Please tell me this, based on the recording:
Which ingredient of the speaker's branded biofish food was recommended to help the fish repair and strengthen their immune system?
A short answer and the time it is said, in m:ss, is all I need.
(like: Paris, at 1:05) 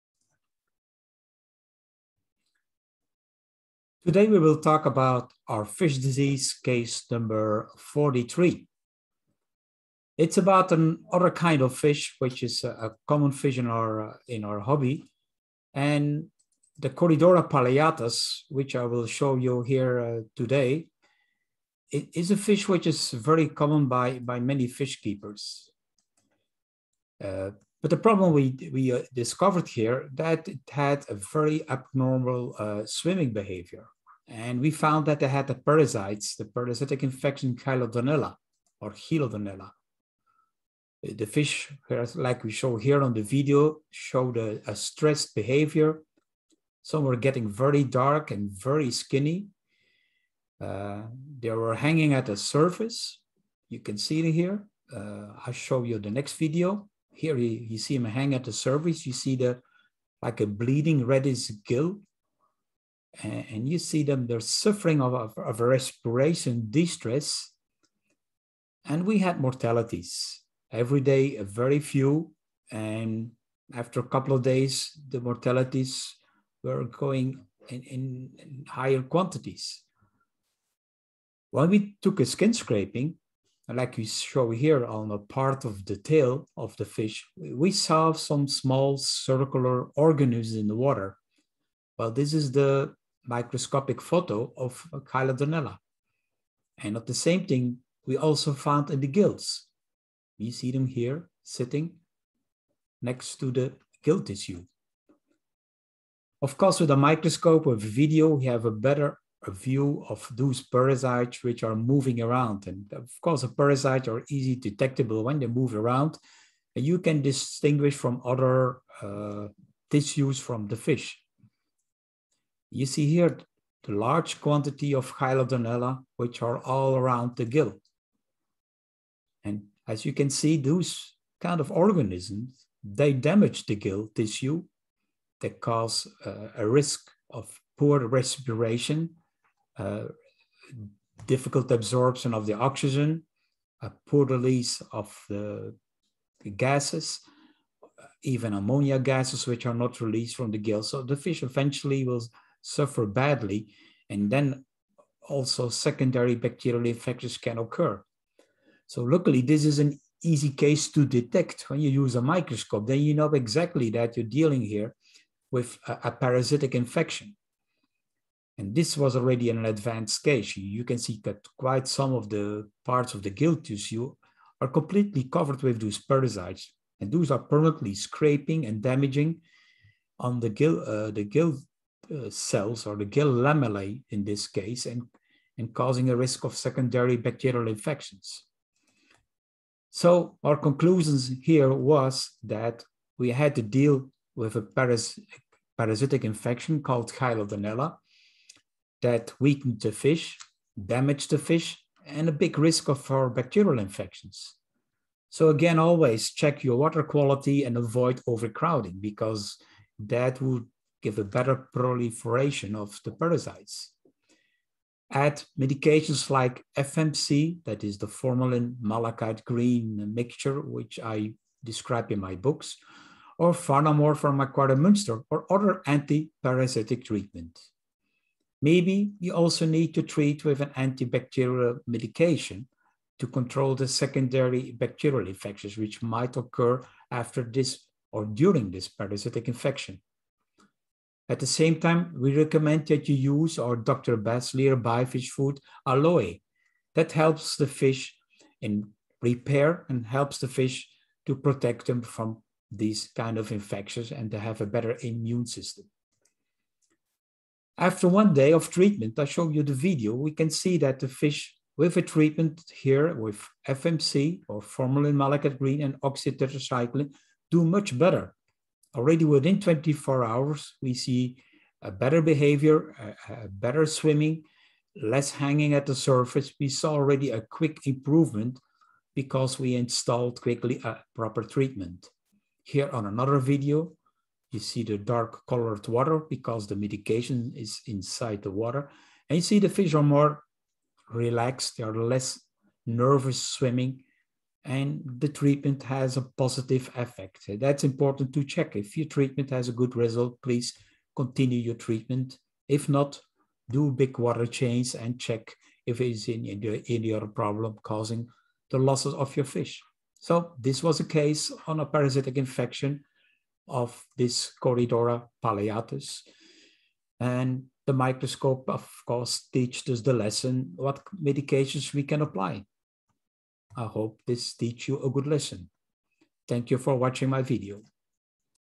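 aloe, at 4:05.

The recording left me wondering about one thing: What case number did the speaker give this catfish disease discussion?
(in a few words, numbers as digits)
43.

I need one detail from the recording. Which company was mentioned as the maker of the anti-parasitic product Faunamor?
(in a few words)
Aquarium Münster.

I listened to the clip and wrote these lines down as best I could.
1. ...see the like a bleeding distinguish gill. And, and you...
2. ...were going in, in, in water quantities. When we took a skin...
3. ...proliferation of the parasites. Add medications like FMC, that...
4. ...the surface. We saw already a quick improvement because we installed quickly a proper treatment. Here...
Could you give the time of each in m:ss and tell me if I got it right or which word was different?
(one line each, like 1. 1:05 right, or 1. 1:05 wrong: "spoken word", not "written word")
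1. 0:59 wrong: "reddish", not "distinguish"
2. 1:16 wrong: "higher", not "water"
3. 3:31 right
4. 4:35 right.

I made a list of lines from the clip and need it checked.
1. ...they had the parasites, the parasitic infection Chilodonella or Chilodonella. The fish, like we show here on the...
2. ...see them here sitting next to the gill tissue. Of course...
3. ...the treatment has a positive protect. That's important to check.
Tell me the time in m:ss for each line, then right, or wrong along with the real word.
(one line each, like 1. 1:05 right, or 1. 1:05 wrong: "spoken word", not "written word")
1. 0:35 right
2. 1:40 right
3. 4:55 wrong: "effect", not "protect".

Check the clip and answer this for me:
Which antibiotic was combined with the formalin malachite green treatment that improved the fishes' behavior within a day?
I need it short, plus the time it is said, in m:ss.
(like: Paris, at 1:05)
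oxytetracycline, at 4:26.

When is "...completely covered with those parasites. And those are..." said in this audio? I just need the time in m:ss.
2:54.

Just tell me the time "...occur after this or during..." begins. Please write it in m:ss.
3:56.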